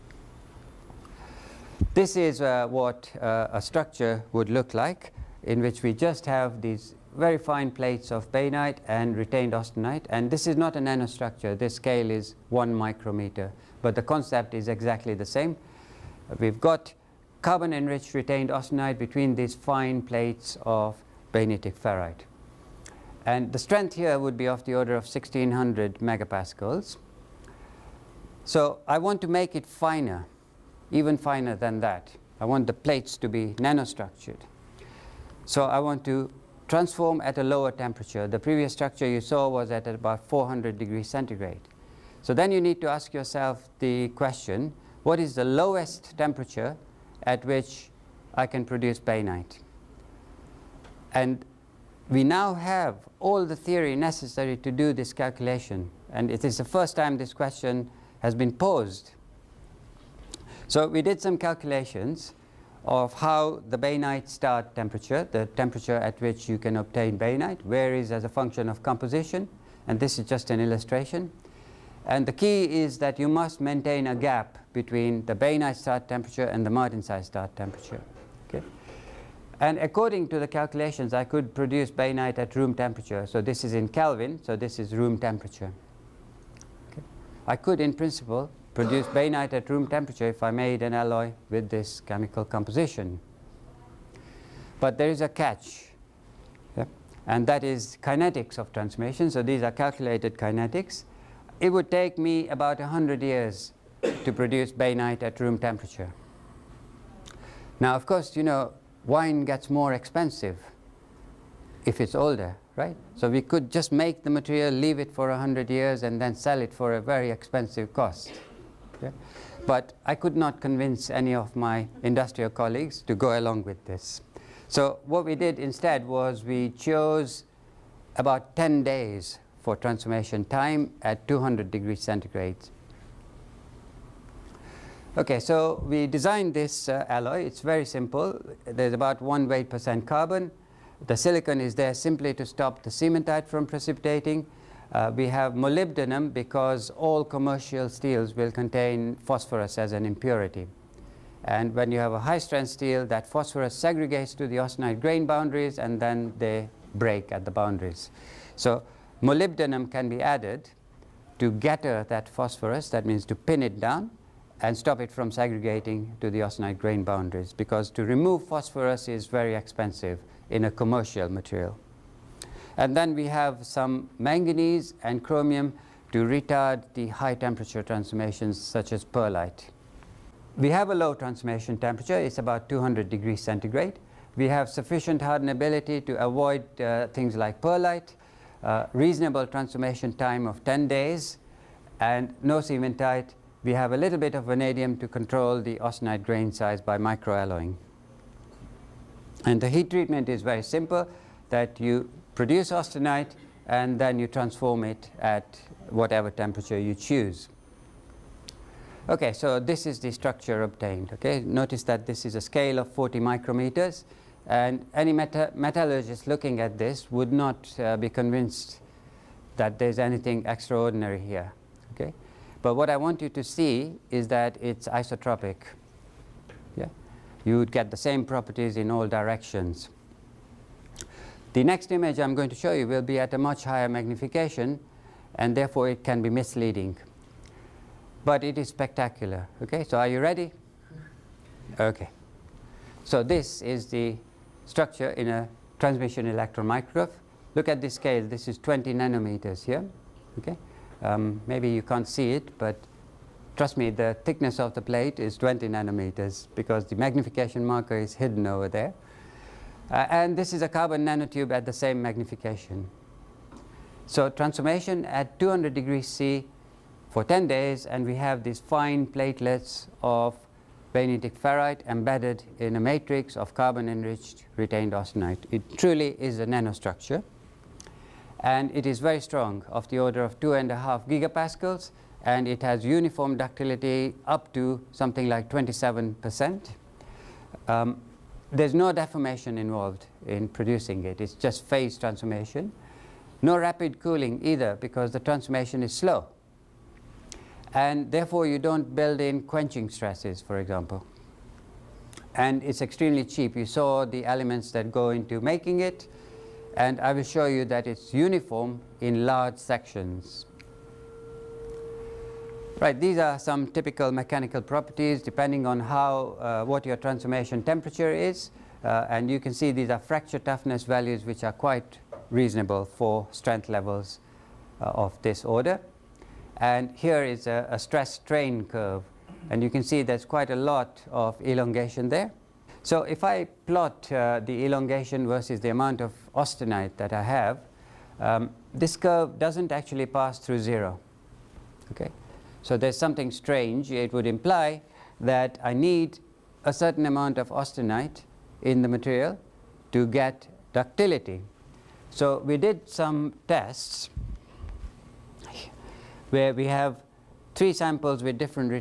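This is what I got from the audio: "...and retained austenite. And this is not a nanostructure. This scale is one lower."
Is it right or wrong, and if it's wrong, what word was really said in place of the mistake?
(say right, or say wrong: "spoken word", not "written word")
wrong: "micrometer", not "lower".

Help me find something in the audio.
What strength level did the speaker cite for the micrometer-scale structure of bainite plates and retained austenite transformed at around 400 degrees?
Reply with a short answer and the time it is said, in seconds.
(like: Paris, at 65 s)
1600 megapascals, at 25 s.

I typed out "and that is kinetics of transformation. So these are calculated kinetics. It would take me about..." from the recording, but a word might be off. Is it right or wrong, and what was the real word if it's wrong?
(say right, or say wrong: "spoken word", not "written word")
right.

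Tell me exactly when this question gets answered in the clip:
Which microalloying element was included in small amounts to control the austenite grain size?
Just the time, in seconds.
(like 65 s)
194 s.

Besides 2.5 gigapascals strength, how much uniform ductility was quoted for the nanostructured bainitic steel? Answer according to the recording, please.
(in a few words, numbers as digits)
27 percent.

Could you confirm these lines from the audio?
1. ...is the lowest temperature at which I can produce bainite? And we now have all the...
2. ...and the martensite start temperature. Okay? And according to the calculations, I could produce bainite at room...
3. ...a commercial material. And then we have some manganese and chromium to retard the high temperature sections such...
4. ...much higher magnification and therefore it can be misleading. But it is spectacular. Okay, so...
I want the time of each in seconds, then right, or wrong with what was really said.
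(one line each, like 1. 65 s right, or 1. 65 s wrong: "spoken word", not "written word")
1. 45 s right
2. 76 s right
3. 170 s wrong: "transformations", not "sections"
4. 233 s right.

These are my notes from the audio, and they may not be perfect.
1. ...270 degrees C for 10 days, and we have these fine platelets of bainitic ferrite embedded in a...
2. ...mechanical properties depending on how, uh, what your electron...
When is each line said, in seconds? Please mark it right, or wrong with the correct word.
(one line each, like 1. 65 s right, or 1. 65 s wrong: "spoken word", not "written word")
1. 265 s wrong: "200", not "270"
2. 314 s wrong: "transformation", not "electron".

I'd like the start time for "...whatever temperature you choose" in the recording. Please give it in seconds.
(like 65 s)
205 s.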